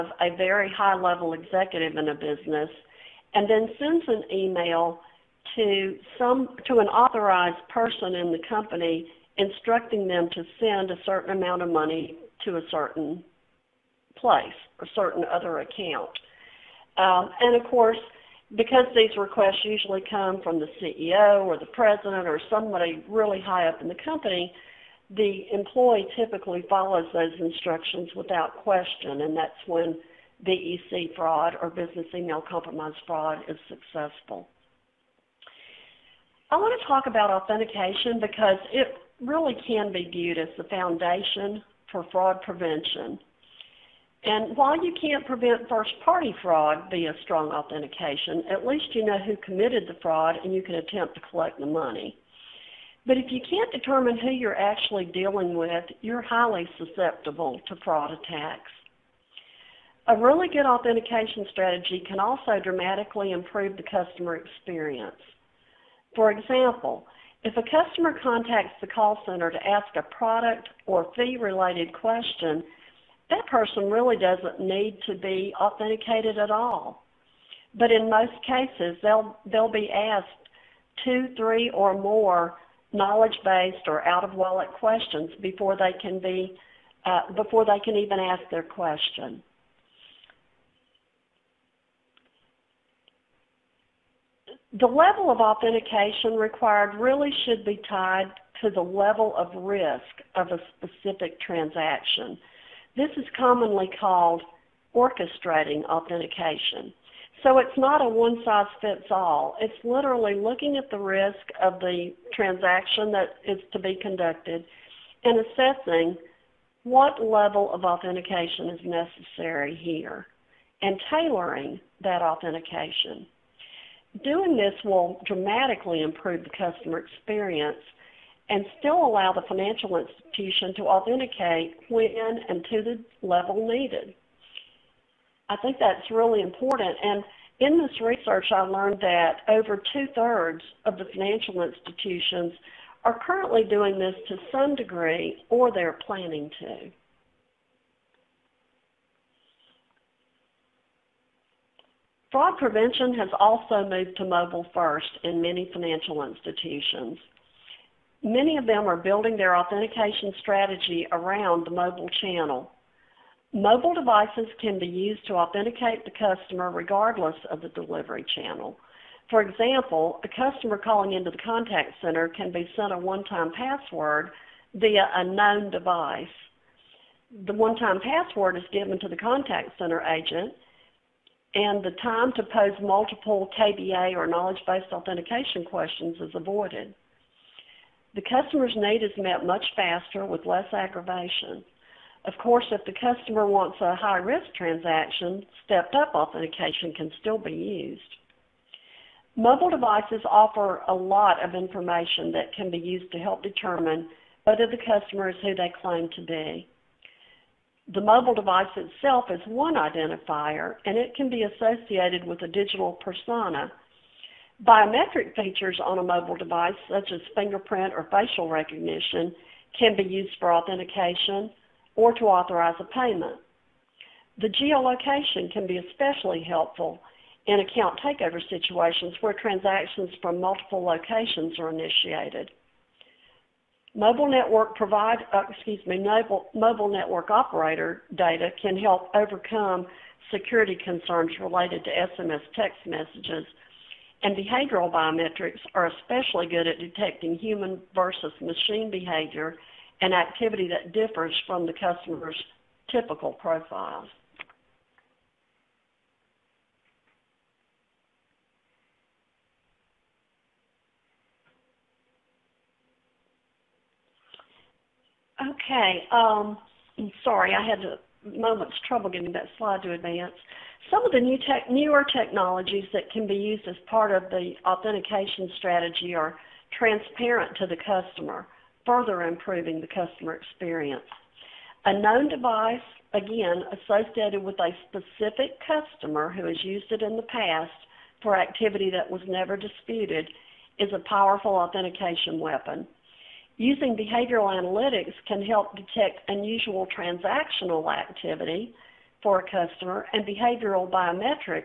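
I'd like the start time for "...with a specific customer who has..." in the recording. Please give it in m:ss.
4:44.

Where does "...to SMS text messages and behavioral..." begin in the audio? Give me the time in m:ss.
4:01.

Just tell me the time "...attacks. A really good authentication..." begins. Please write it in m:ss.
0:58.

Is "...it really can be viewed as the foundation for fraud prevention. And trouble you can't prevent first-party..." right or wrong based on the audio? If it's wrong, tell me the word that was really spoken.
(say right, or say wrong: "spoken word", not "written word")
wrong: "while", not "trouble".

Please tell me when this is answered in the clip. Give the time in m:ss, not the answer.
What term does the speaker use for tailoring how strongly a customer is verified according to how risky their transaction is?
1:44.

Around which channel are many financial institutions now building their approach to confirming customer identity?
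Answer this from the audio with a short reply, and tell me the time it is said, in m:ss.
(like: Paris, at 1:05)
mobile channel, at 2:41.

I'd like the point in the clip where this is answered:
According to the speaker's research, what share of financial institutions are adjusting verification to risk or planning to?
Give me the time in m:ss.
2:19.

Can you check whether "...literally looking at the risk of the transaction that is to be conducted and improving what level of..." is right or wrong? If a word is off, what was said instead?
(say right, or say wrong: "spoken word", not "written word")
wrong: "assessing", not "improving".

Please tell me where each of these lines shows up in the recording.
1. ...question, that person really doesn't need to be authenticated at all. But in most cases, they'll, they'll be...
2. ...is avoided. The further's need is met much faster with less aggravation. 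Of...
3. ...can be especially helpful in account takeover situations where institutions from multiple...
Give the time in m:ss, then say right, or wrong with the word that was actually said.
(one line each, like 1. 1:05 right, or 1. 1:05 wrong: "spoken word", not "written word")
1. 1:11 right
2. 3:06 wrong: "customer", not "further"
3. 3:45 wrong: "transactions", not "institutions".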